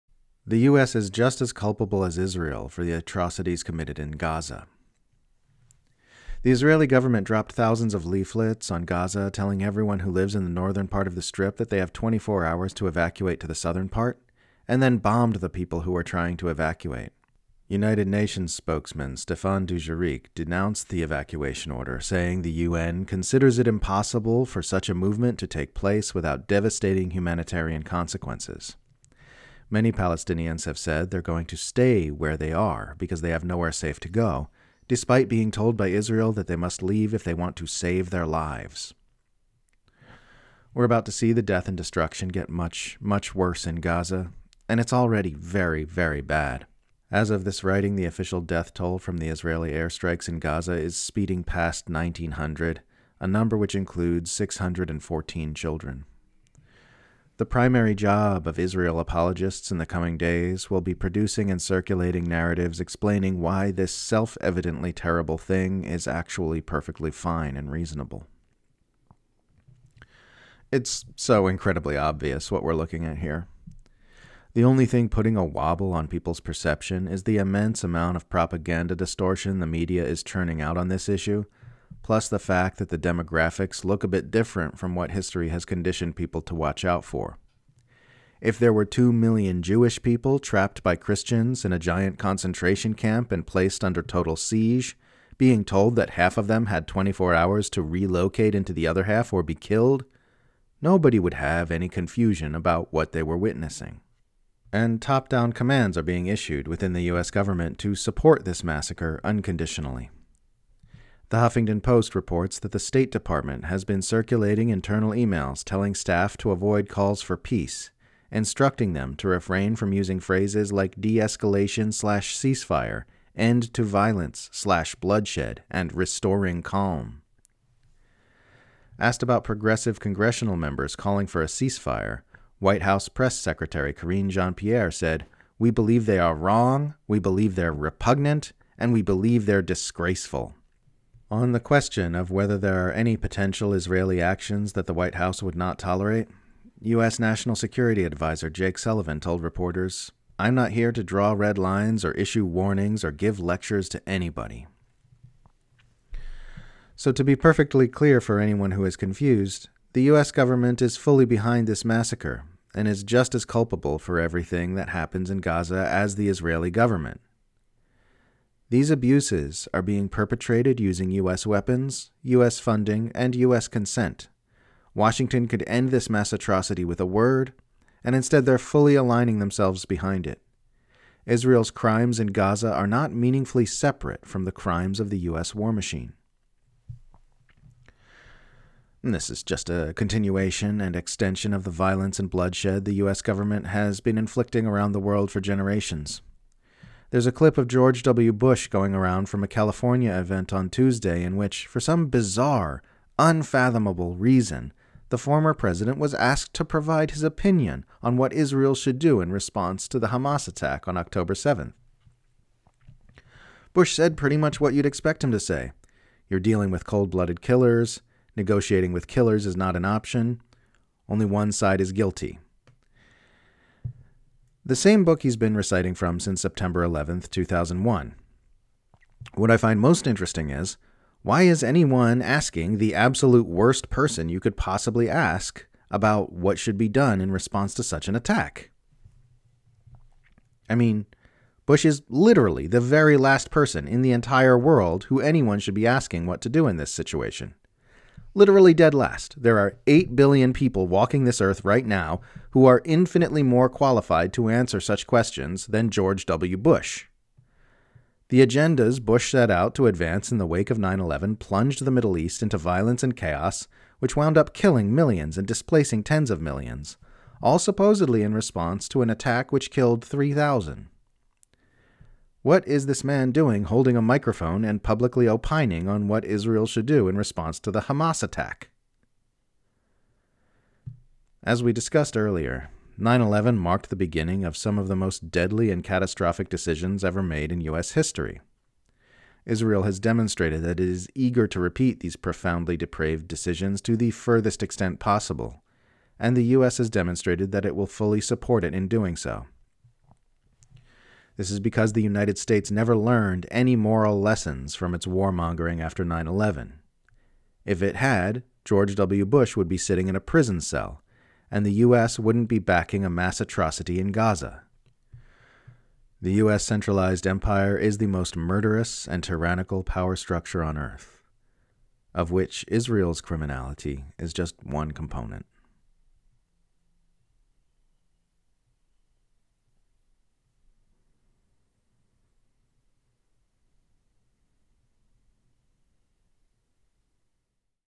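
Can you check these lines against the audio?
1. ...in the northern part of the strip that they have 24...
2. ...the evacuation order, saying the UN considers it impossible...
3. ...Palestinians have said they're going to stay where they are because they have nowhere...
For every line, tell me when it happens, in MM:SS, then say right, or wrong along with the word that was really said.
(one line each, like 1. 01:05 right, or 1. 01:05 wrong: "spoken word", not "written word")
1. 00:10 right
2. 00:20 right
3. 00:29 right.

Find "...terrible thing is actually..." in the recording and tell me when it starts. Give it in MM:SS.
01:04.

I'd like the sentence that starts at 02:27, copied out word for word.
National Security Advisor Jake Sullivan told reporters, I'm not here to draw red lines or issue warnings or give lectures to anybody.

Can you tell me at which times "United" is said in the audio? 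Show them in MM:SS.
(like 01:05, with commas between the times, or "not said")
00:17, 05:02.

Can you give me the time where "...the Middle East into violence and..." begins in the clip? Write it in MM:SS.
04:21.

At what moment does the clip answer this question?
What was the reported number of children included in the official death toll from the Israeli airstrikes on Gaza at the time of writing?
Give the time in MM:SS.
00:54.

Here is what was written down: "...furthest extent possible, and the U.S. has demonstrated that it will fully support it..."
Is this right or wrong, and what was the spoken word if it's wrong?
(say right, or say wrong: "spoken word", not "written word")
right.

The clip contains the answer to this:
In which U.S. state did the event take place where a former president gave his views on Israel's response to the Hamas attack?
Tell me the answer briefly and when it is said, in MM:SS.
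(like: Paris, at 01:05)
California, at 03:19.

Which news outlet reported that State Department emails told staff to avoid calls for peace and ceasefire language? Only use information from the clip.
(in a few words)
The Huffington Post.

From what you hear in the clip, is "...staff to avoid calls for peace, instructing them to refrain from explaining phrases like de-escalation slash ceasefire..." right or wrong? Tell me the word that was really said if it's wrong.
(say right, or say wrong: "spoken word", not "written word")
wrong: "using", not "explaining".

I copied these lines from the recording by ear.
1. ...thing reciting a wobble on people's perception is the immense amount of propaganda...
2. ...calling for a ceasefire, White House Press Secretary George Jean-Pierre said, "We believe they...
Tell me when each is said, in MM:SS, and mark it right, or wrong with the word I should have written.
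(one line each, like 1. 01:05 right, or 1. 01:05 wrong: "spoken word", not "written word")
1. 01:14 wrong: "putting", not "reciting"
2. 02:10 wrong: "Karine", not "George".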